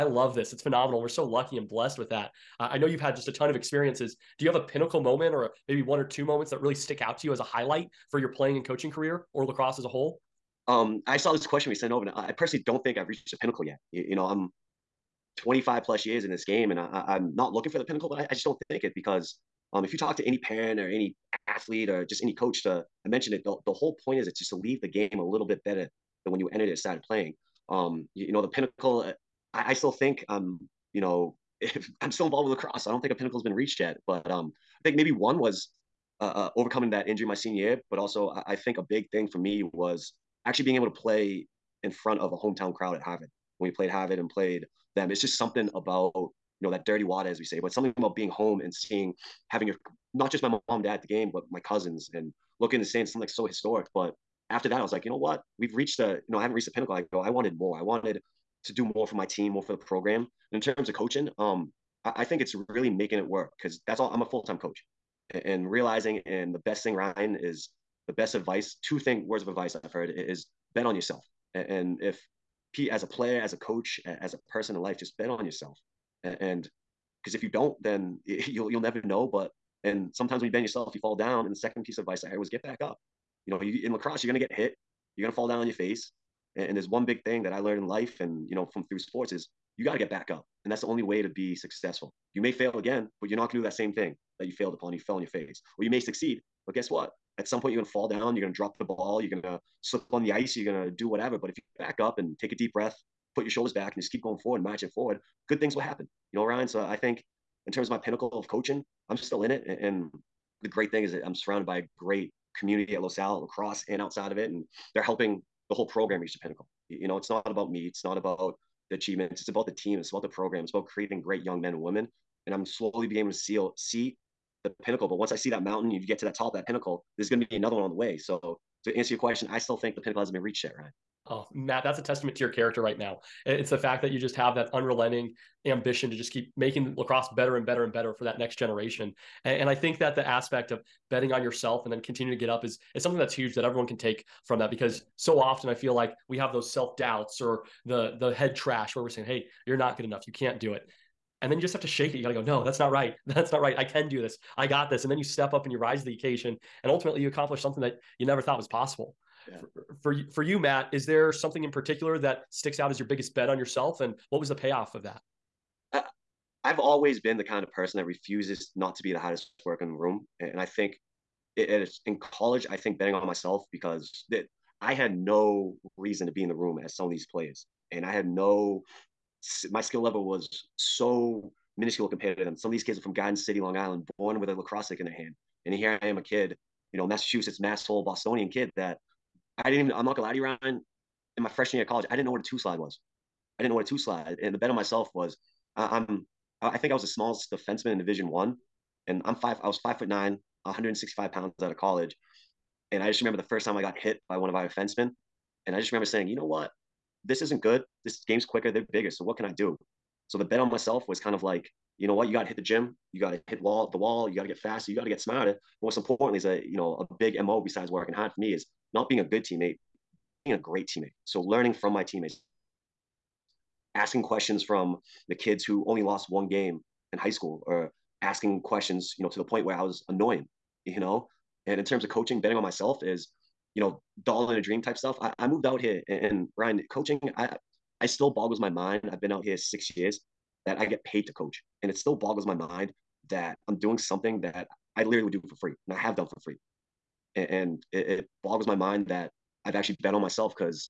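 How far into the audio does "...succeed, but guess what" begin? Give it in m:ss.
1:35.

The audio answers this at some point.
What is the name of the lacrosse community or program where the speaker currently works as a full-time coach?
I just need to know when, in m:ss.
1:53.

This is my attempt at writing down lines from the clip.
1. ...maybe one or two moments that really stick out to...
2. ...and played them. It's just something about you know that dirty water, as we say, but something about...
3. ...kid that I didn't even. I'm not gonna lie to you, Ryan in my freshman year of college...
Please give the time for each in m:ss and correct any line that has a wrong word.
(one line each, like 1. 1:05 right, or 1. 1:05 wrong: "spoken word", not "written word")
1. 0:05 right
2. 0:44 right
3. 3:08 right.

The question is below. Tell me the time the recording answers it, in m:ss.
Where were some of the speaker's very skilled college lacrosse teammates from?
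3:03.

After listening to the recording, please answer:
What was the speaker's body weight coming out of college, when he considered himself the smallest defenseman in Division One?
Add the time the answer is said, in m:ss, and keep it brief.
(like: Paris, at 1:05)
165 pounds, at 3:20.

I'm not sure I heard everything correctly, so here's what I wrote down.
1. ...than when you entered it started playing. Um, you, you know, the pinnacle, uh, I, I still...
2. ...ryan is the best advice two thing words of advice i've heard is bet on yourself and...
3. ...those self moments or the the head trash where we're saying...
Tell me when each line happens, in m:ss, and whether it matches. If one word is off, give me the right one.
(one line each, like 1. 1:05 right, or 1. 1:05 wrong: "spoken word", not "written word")
1. 0:26 right
2. 1:06 right
3. 2:26 wrong: "doubts", not "moments".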